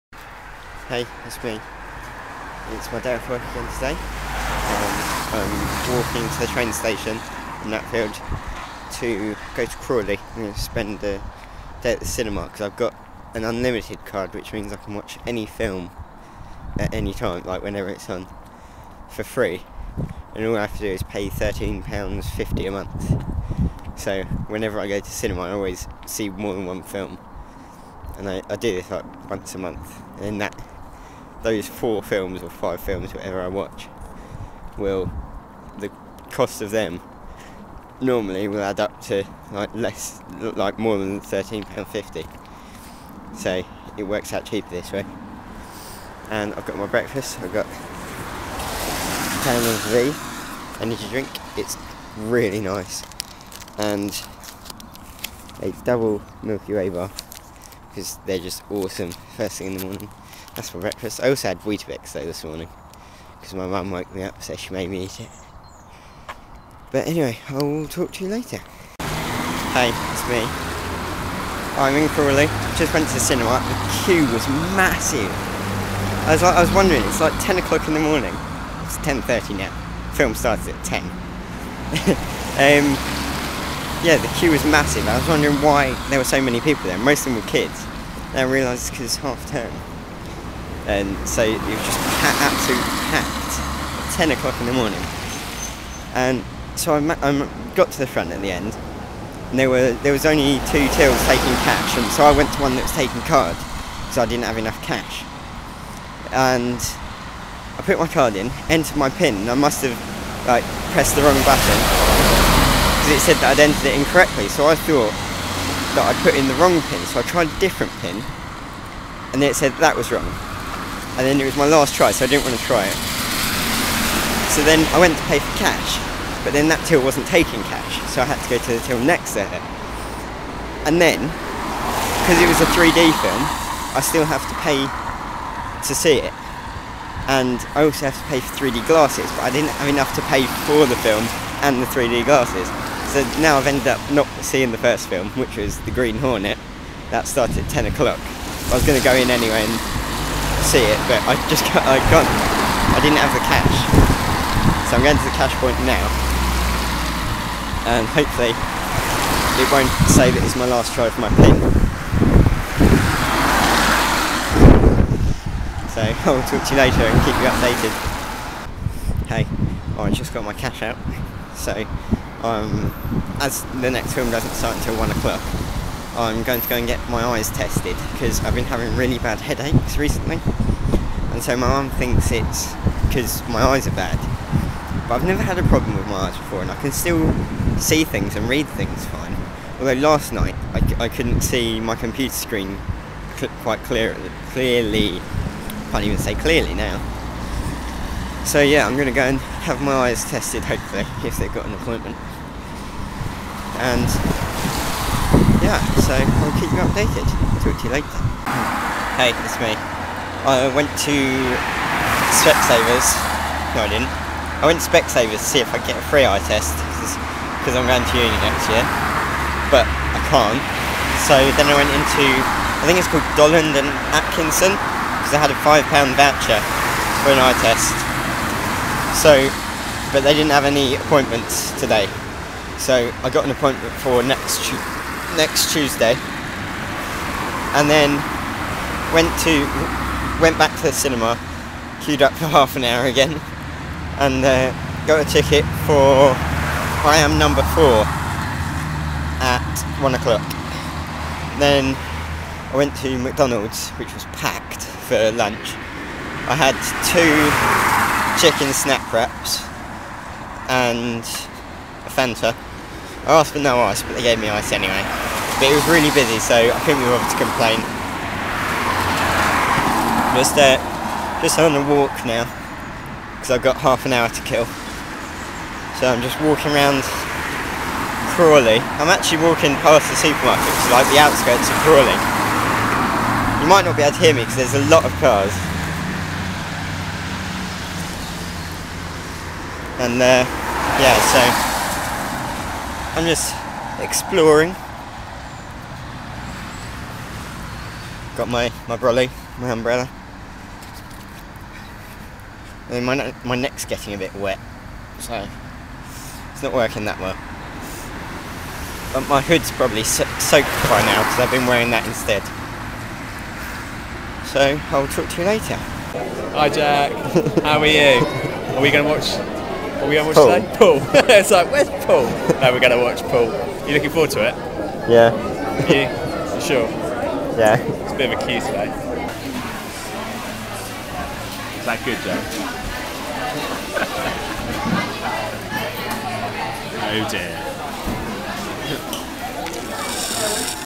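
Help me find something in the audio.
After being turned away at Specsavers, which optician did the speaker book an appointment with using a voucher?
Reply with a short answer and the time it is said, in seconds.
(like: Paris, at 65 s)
Dollond and Atkinson, at 223 s.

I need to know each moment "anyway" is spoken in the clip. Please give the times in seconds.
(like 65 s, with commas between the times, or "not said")
67 s, 149 s, 264 s.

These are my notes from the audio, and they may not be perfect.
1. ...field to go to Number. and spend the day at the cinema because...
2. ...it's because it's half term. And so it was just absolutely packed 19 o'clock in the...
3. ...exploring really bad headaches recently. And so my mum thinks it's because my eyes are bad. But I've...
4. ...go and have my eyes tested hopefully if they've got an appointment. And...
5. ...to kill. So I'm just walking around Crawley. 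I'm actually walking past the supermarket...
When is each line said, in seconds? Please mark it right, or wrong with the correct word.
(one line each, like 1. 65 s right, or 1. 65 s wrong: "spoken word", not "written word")
1. 7 s wrong: "Crawley", not "Number"
2. 88 s wrong: "10", not "19"
3. 178 s wrong: "having", not "exploring"
4. 199 s right
5. 274 s right.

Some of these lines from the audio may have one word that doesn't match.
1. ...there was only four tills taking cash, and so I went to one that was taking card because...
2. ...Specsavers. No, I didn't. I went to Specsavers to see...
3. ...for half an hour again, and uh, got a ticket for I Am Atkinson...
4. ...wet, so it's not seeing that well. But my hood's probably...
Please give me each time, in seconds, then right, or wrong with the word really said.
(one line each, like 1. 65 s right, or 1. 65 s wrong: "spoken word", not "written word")
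1. 100 s wrong: "two", not "four"
2. 212 s right
3. 242 s wrong: "Number", not "Atkinson"
4. 304 s wrong: "working", not "seeing".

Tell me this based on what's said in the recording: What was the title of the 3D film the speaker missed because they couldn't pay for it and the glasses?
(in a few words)
The Green Hornet.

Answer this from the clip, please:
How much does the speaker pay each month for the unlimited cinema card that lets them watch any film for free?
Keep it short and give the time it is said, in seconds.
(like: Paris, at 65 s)
£13.50, at 21 s.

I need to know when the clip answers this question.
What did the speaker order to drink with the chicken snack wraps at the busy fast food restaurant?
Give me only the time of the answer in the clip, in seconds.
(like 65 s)
262 s.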